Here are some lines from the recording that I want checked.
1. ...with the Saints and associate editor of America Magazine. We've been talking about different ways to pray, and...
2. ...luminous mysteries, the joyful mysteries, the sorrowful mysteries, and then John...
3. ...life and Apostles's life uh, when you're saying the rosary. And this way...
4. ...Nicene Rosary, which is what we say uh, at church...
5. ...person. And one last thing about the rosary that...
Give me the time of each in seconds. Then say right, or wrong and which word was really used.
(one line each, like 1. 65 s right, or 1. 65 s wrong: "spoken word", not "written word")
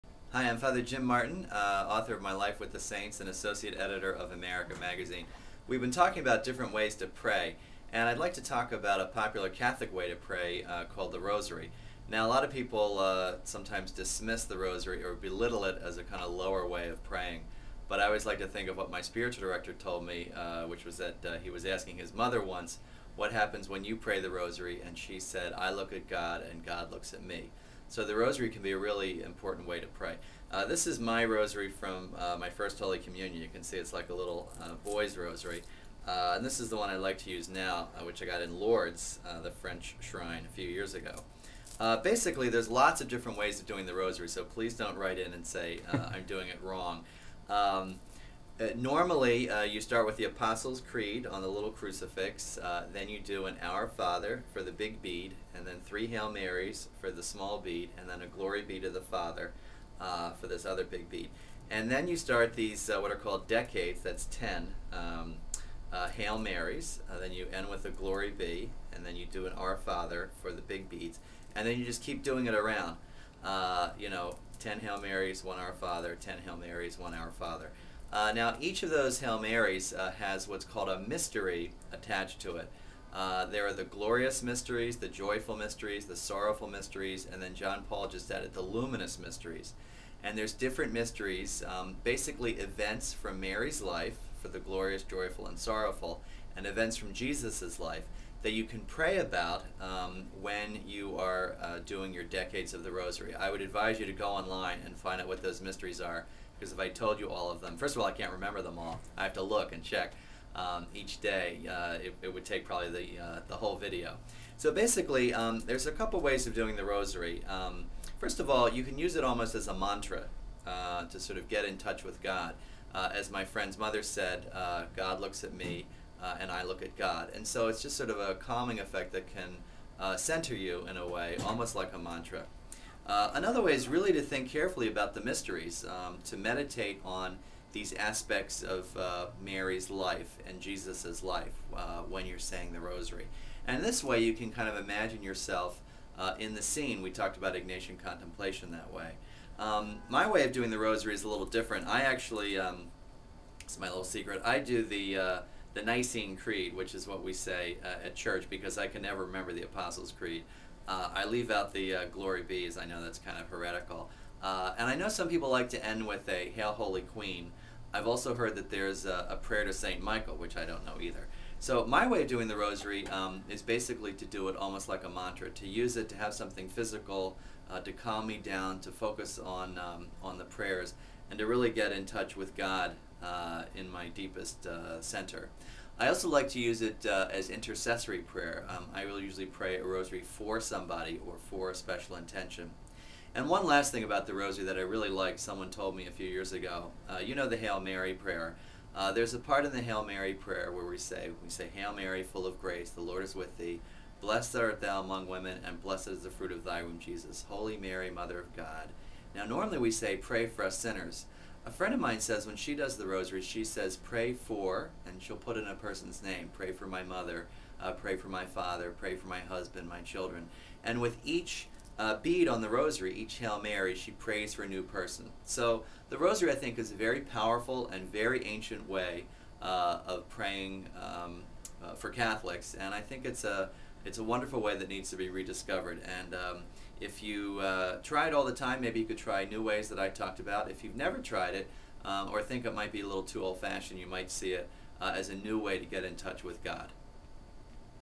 1. 2 s right
2. 83 s wrong: "glorious", not "luminous"
3. 139 s wrong: "Jesus", not "Apostles"
4. 155 s wrong: "Creed", not "Rosary"
5. 192 s wrong: "intention", not "person".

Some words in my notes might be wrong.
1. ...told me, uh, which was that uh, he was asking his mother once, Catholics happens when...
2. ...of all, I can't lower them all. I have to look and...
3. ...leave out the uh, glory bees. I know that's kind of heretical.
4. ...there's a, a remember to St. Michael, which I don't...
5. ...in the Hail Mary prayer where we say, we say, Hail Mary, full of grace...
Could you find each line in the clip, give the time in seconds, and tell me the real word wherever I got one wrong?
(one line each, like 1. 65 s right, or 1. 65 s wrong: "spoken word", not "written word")
1. 19 s wrong: "What", not "Catholics"
2. 107 s wrong: "remember", not "lower"
3. 161 s right
4. 168 s wrong: "prayer", not "remember"
5. 199 s right.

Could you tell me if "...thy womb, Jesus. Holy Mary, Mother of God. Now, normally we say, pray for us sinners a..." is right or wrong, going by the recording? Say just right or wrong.
right.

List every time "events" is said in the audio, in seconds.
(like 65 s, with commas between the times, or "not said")
92 s, 96 s.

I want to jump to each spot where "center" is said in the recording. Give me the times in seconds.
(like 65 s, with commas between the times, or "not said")
130 s, 185 s.